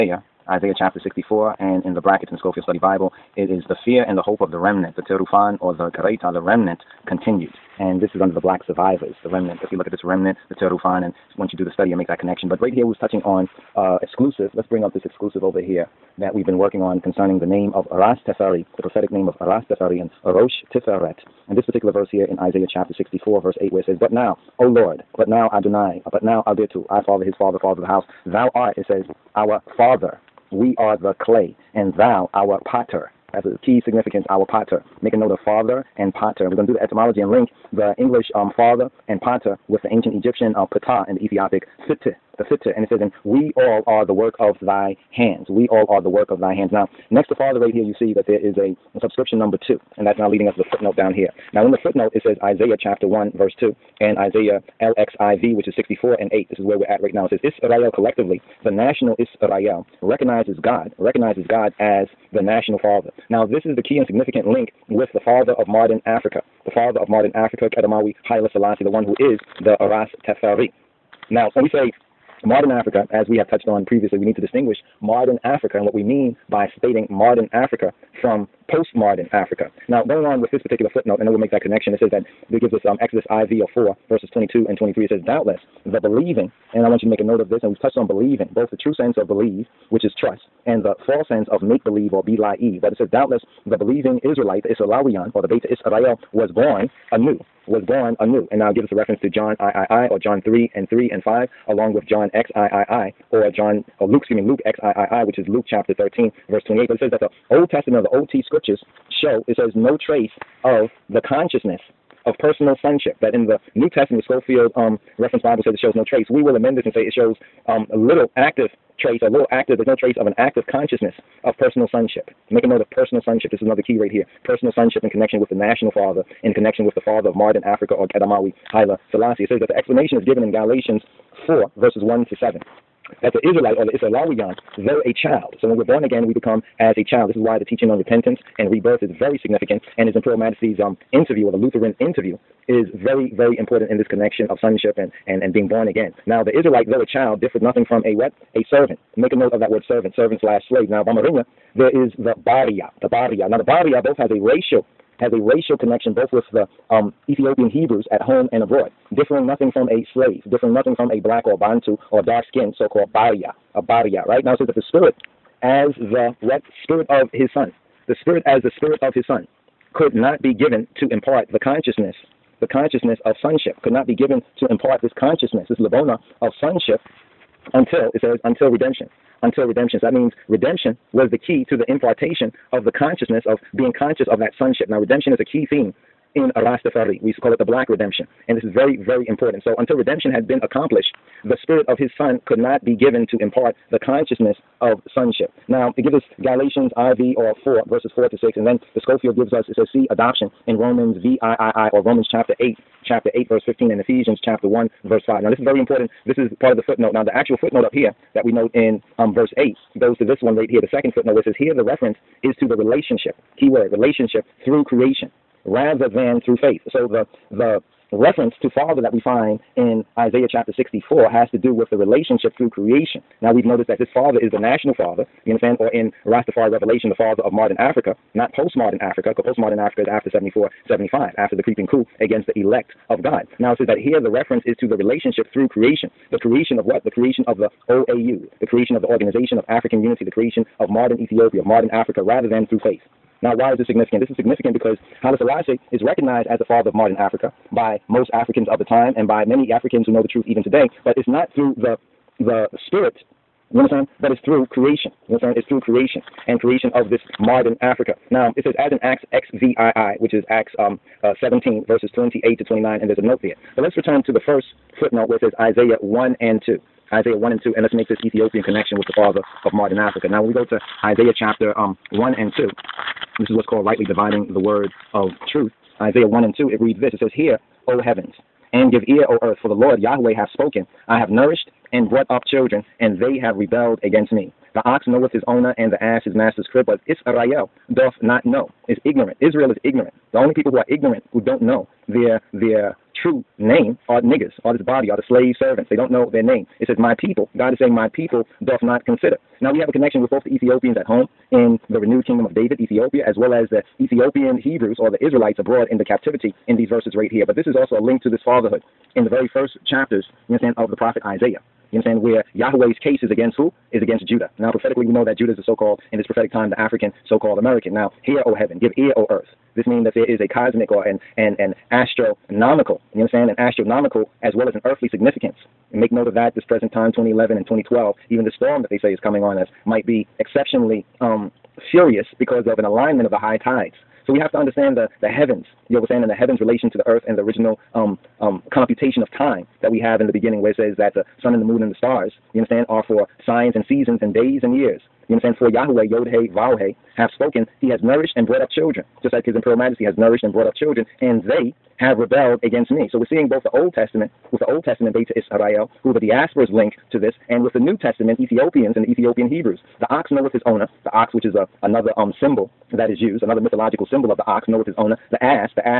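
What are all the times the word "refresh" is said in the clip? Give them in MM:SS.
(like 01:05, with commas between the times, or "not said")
not said.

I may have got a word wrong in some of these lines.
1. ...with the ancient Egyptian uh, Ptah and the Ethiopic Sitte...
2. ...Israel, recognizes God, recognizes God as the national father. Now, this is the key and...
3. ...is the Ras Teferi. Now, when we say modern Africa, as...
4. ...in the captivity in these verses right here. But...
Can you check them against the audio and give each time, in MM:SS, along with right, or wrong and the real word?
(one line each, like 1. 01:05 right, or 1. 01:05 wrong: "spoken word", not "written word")
1. 00:39 right
2. 00:59 right
3. 01:09 right
4. 05:05 right.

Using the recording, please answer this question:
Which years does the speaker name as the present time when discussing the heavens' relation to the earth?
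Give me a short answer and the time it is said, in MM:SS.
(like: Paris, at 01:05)
2011 and 2012, at 05:27.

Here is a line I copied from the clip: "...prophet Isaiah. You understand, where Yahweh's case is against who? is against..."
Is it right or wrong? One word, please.
right.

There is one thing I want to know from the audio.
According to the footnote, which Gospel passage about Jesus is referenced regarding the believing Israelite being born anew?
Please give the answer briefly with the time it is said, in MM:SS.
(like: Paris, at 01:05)
Luke 13:28, at 01:45.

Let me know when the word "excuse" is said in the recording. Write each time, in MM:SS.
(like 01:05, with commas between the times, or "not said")
01:44.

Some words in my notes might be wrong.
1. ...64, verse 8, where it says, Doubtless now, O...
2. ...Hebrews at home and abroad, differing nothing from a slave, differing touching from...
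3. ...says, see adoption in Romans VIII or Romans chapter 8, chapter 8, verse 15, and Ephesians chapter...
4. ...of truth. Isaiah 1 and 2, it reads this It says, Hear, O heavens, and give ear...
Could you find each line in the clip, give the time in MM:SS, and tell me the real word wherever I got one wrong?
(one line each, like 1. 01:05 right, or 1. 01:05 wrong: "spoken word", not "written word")
1. 00:22 wrong: "But", not "Doubtless"
2. 02:37 wrong: "nothing", not "touching"
3. 03:19 right
4. 04:35 right.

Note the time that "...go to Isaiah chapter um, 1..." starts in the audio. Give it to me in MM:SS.
04:30.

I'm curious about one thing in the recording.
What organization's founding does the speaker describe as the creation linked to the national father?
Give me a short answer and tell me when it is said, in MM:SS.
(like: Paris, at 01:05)
Organization of African Unity, at 03:59.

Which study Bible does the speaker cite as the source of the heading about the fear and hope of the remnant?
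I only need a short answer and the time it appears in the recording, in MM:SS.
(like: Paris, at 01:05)
Scofield Study Bible, at 00:02.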